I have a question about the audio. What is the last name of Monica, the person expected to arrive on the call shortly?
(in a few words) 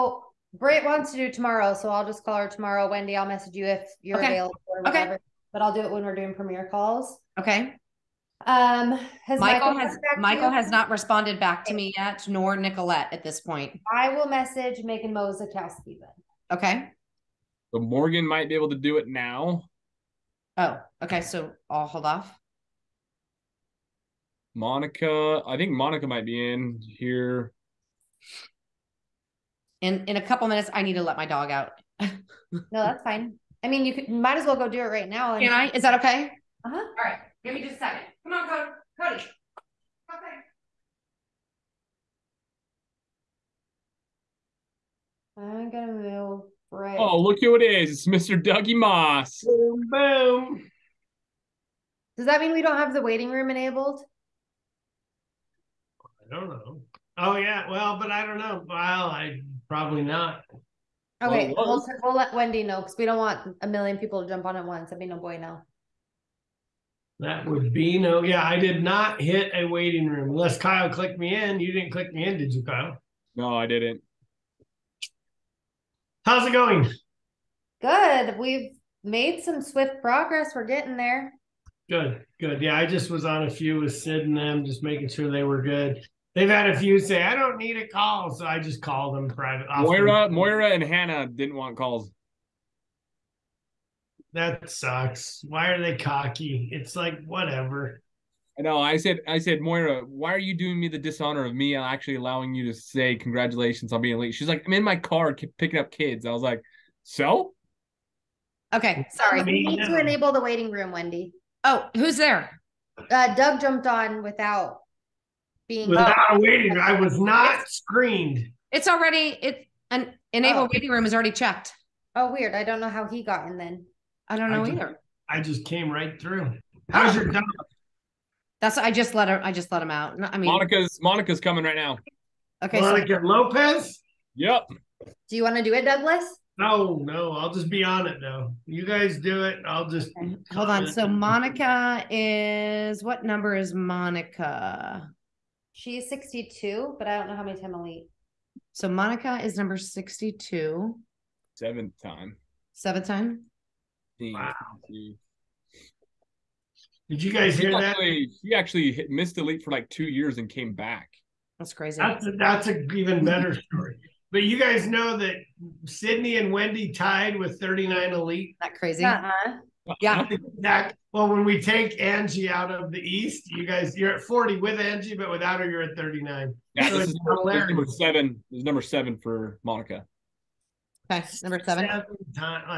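Lopez.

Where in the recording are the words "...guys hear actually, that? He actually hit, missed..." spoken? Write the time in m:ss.
2:37.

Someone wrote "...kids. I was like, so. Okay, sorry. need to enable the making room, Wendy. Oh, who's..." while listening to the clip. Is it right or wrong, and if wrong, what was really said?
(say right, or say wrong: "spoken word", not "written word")
wrong: "waiting", not "making".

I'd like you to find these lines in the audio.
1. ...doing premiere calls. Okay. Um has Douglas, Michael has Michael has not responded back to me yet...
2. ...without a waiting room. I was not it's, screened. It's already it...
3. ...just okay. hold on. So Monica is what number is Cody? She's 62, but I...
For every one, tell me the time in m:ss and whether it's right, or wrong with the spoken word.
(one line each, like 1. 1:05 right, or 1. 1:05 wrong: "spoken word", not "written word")
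1. 0:06 wrong: "Michael", not "Douglas"
2. 1:55 right
3. 2:19 wrong: "Monica", not "Cody".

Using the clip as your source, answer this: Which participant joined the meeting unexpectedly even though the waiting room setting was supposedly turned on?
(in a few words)
Doug.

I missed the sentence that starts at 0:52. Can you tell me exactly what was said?
Does that mean we don't have the waiting room enabled?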